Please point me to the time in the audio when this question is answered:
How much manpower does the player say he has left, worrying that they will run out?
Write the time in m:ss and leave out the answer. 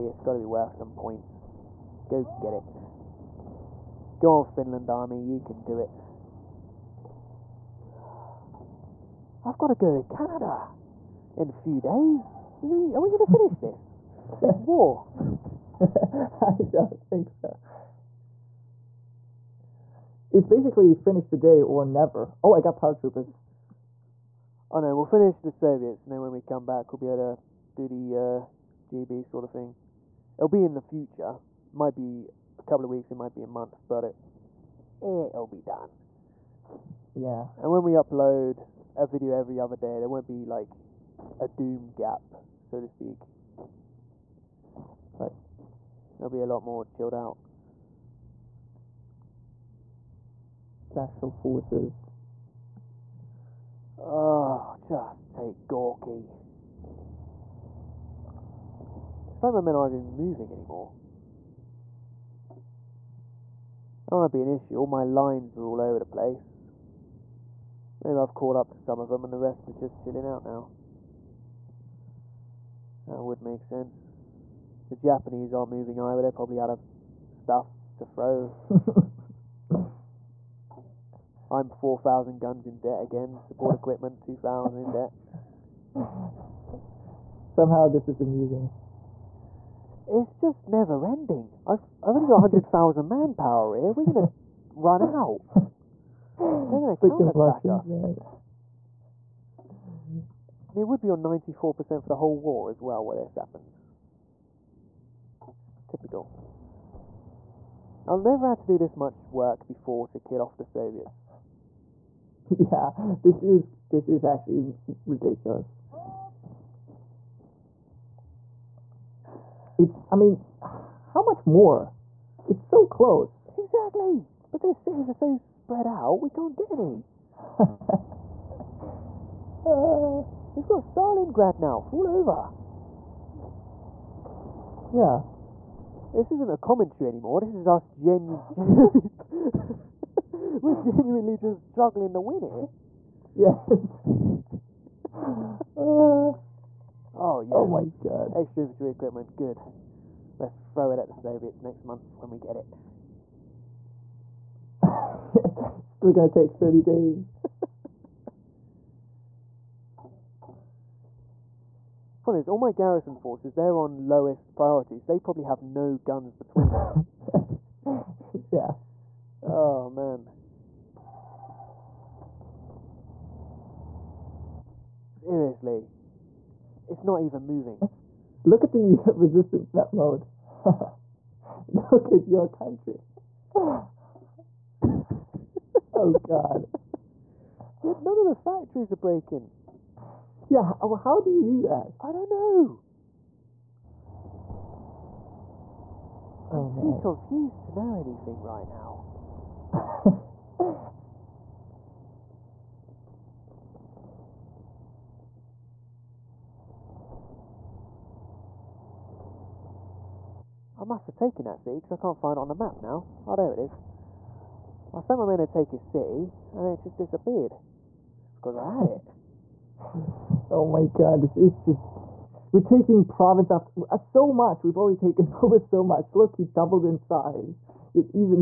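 1:32.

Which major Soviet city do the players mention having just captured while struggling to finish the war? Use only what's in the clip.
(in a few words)
Stalingrad.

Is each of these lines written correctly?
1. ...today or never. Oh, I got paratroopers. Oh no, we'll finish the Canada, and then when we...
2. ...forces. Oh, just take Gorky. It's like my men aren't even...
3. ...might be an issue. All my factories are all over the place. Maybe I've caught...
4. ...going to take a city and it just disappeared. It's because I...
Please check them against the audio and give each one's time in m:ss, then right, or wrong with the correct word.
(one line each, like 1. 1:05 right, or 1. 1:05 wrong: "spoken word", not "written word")
1. 0:21 wrong: "Soviets", not "Canada"
2. 0:51 right
3. 1:04 wrong: "lines", not "factories"
4. 3:35 right.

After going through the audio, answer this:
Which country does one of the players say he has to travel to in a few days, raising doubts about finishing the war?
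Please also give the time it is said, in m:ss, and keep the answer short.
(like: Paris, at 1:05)
Canada, at 0:10.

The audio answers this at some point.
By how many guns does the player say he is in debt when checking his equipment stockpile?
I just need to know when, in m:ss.
1:21.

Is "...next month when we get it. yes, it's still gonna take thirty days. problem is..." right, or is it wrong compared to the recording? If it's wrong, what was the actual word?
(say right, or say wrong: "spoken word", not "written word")
right.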